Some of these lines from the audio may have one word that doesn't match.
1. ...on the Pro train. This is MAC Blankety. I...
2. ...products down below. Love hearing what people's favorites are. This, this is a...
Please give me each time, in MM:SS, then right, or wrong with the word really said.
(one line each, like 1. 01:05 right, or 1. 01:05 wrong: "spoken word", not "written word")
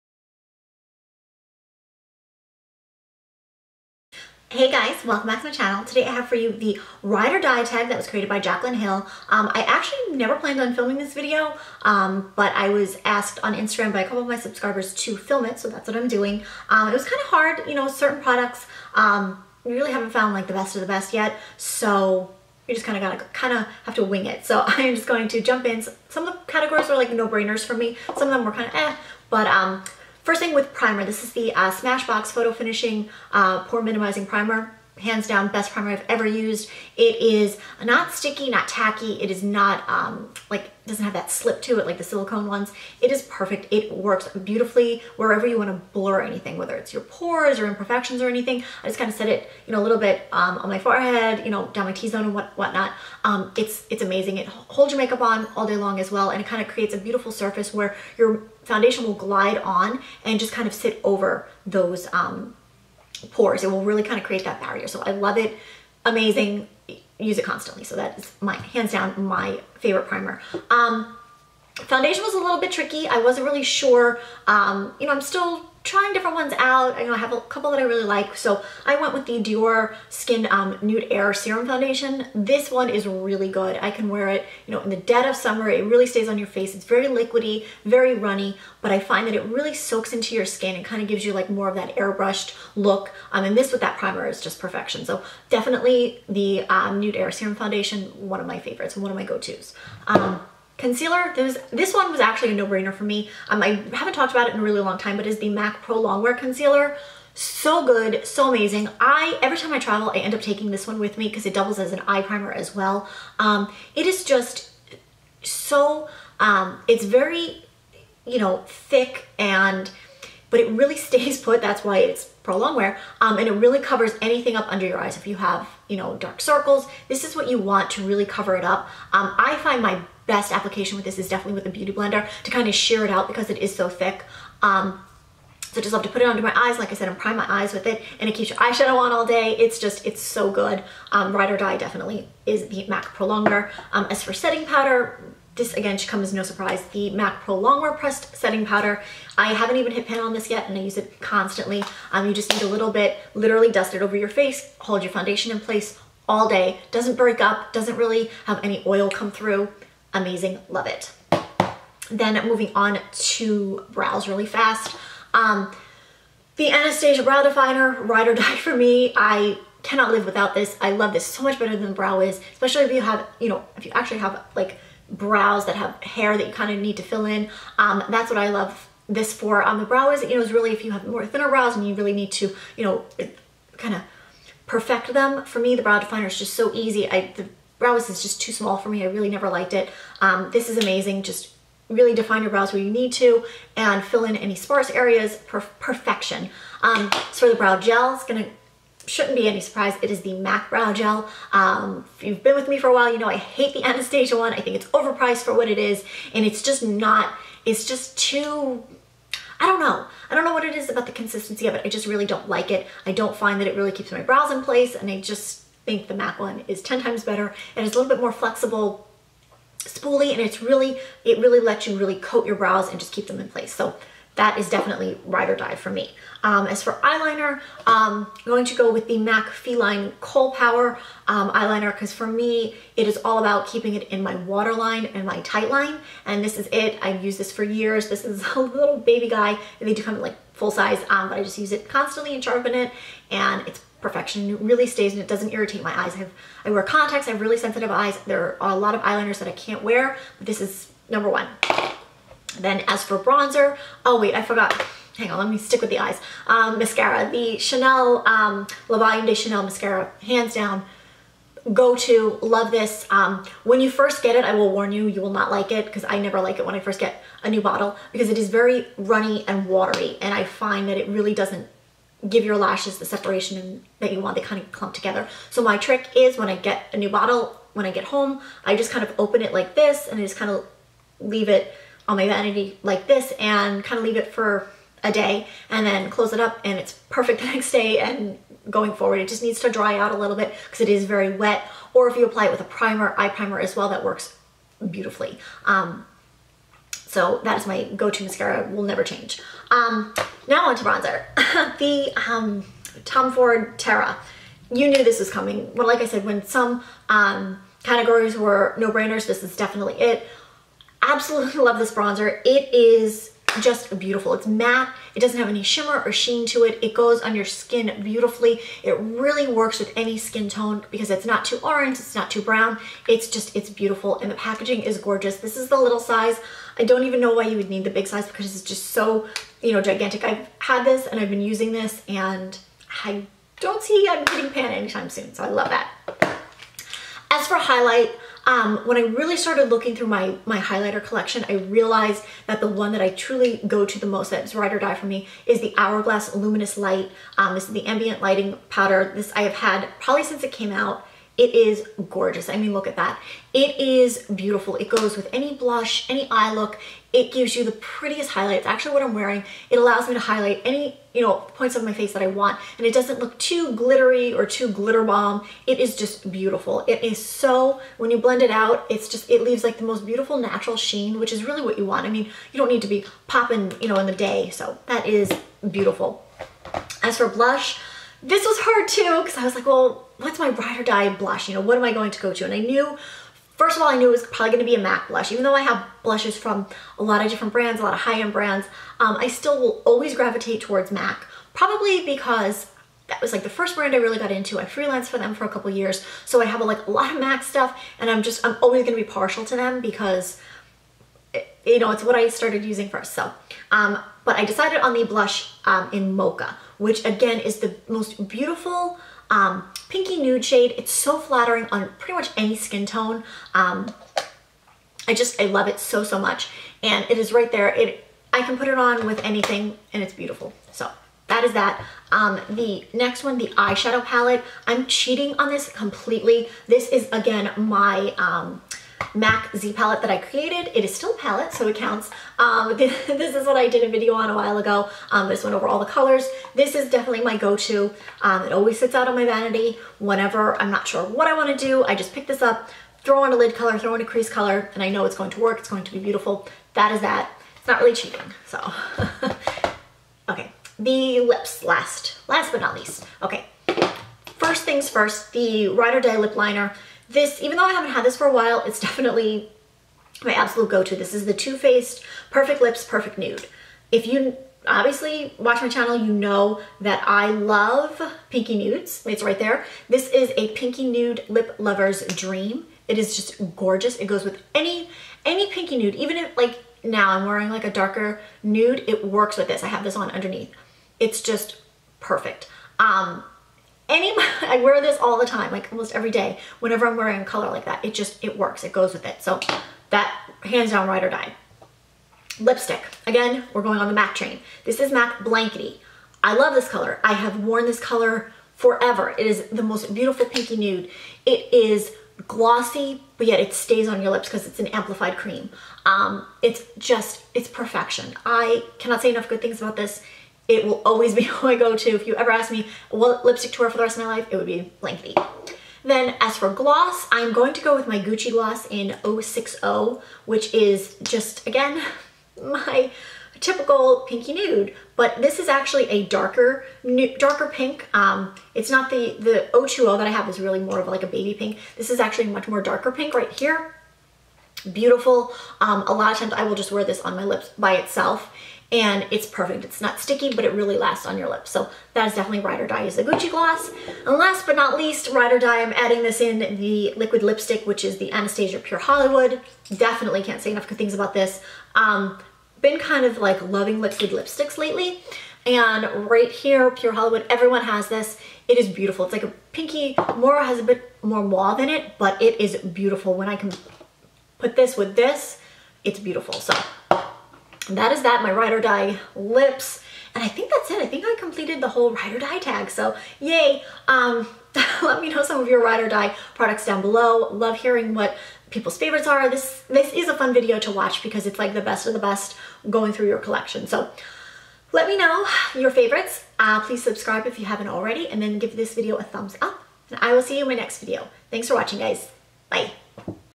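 1. 08:13 wrong: "MAC", not "Pro"
2. 09:36 right.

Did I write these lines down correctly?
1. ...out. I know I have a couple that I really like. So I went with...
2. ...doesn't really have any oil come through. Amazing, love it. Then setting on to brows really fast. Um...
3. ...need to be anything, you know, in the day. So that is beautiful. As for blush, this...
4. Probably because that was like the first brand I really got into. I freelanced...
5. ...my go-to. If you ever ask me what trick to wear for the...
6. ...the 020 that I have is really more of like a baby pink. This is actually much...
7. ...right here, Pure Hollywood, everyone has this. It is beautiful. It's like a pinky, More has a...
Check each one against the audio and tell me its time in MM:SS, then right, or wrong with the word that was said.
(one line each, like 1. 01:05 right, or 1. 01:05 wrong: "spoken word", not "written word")
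1. 01:16 right
2. 02:37 wrong: "moving", not "setting"
3. 06:12 wrong: "popping", not "anything"
4. 06:31 right
5. 08:31 wrong: "lipstick", not "trick"
6. 08:49 right
7. 09:16 right.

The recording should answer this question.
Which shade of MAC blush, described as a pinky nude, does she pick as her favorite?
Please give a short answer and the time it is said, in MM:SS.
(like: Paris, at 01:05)
Mocha, at 06:46.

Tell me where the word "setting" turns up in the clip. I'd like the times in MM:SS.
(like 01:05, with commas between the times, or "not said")
02:24, 02:28.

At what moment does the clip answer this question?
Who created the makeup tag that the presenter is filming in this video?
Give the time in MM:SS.
00:08.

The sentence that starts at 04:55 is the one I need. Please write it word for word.
Um, so that is my go-to mascara, will never change.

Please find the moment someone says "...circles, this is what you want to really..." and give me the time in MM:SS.
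02:06.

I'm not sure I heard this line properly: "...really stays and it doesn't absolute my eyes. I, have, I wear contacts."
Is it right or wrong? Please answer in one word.
wrong.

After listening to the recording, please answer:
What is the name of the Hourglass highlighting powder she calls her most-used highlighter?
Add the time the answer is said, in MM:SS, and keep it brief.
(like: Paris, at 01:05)
Luminous Light, at 05:46.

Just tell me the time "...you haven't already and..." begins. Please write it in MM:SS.
09:47.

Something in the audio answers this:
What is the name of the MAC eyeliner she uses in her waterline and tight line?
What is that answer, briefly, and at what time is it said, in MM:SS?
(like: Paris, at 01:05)
Feline Kohl Power, at 03:49.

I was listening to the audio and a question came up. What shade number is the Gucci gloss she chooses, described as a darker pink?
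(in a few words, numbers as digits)
060.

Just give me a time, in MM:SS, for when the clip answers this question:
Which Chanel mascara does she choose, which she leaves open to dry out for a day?
04:18.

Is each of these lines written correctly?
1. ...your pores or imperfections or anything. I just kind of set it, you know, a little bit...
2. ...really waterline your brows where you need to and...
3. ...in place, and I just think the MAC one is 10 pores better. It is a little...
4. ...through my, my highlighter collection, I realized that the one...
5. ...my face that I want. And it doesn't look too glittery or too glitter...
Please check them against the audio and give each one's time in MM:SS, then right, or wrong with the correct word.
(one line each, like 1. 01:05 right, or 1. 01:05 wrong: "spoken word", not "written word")
1. 00:46 right
2. 03:11 wrong: "define", not "waterline"
3. 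03:34 wrong: "times", not "pores"
4. 05:39 right
5. 06:01 right.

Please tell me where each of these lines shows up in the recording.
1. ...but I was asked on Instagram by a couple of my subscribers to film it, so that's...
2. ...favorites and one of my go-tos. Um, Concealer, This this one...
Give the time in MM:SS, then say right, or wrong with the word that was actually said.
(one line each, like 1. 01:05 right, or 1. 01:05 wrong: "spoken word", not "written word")
1. 00:12 right
2. 01:38 right.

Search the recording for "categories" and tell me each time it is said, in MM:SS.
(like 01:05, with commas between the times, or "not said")
00:26, 05:07.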